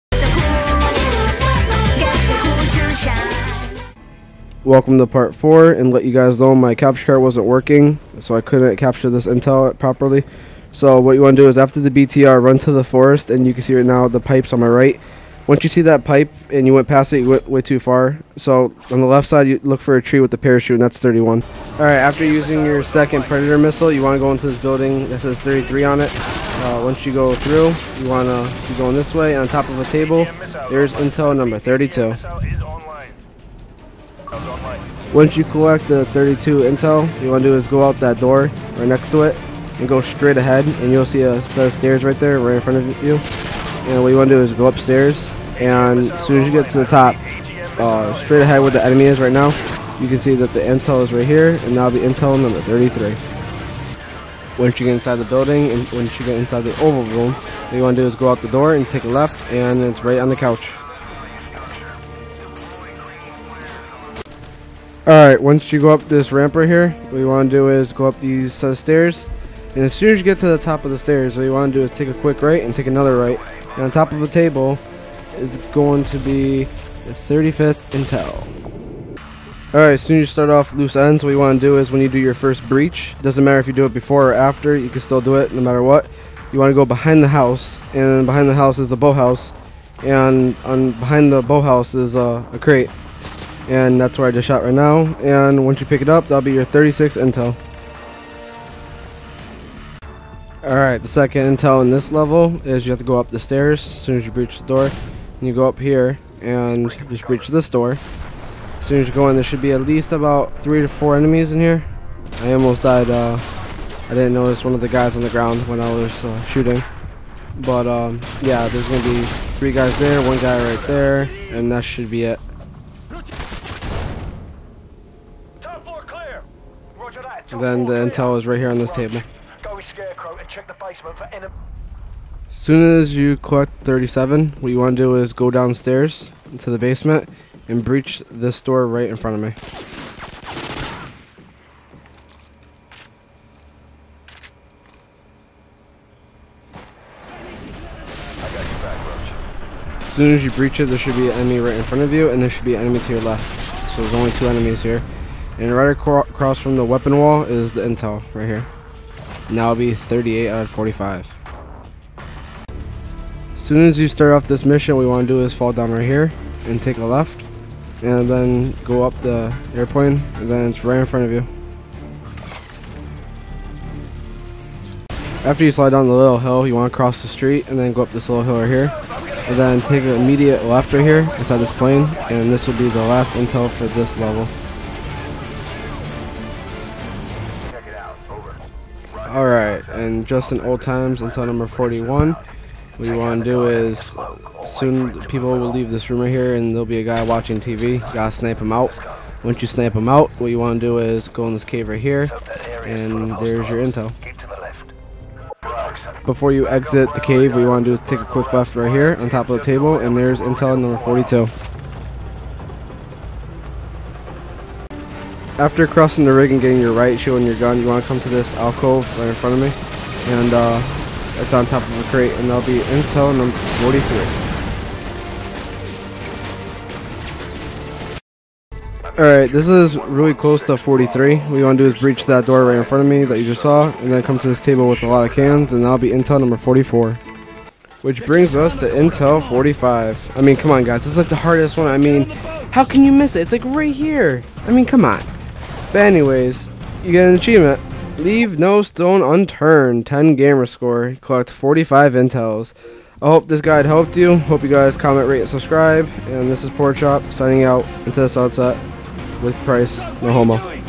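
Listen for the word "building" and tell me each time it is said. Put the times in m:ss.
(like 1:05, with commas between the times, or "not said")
0:24, 0:55.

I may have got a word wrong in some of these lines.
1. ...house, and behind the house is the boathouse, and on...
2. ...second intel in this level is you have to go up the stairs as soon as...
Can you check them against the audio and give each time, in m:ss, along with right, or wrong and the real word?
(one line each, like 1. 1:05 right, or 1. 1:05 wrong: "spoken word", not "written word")
1. 1:27 right
2. 1:41 right.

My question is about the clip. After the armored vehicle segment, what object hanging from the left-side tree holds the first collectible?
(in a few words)
Parachute.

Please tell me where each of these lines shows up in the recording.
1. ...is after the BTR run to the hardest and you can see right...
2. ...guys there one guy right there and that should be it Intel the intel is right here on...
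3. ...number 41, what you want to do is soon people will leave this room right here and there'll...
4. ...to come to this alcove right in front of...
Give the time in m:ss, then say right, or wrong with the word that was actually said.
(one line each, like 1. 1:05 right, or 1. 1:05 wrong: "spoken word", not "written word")
1. 0:11 wrong: "forest", not "hardest"
2. 1:59 wrong: "Then", not "Intel"
3. 3:11 right
4. 3:38 right.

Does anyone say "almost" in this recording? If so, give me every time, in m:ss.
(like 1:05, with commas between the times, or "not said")
1:52.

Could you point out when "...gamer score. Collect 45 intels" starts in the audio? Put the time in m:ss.
4:10.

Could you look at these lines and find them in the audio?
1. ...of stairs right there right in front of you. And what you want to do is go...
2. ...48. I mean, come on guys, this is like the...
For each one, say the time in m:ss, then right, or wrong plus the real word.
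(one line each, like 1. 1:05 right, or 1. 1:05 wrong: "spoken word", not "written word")
1. 0:41 right
2. 3:59 wrong: "45", not "48".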